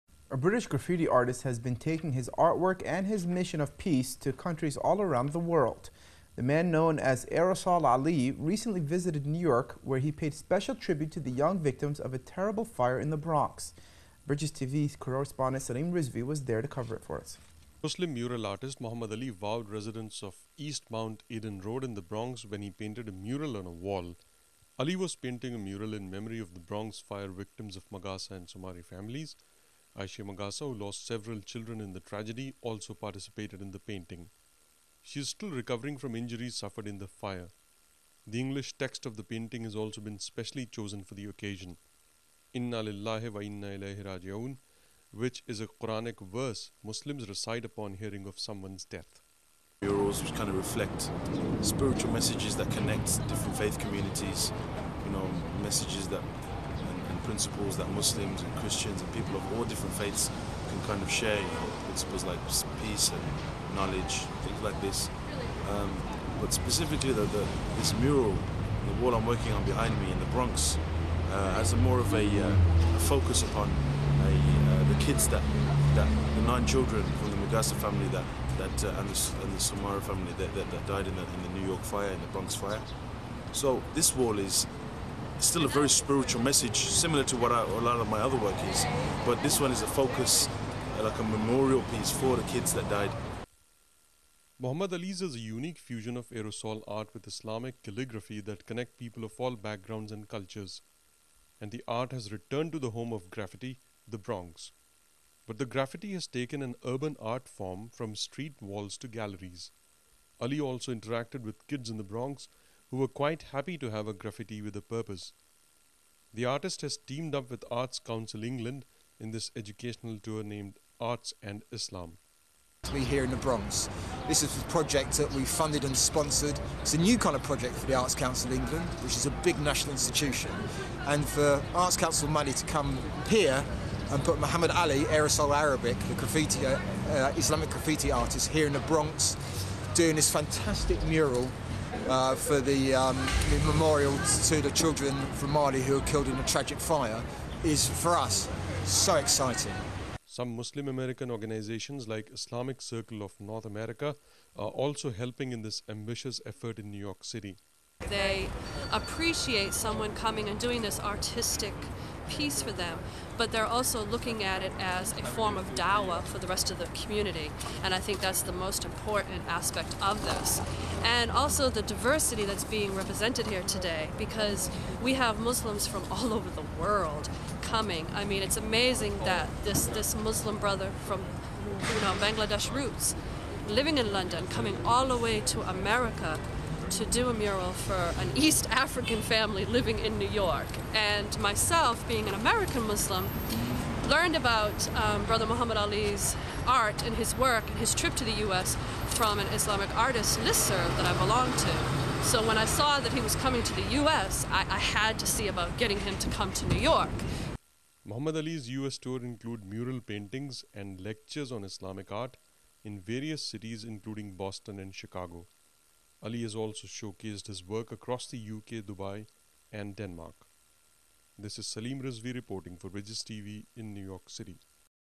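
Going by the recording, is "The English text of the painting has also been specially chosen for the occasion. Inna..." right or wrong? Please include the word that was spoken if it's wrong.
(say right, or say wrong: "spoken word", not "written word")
right.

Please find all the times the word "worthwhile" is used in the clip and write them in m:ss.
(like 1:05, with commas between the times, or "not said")
not said.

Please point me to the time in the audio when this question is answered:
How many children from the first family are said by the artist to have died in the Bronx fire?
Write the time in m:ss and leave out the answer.
1:16.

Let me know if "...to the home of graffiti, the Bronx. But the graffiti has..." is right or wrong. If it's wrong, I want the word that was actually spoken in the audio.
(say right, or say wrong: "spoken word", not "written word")
right.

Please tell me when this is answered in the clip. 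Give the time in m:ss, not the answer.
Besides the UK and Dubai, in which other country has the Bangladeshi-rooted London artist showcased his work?
3:39.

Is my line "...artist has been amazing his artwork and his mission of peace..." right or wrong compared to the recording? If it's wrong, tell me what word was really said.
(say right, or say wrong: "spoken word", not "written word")
wrong: "taking", not "amazing".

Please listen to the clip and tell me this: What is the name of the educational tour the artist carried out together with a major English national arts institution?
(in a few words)
Arts and Islam.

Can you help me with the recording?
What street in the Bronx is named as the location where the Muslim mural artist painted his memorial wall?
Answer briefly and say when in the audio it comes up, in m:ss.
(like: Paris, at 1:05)
East Mount Eden Road, at 0:20.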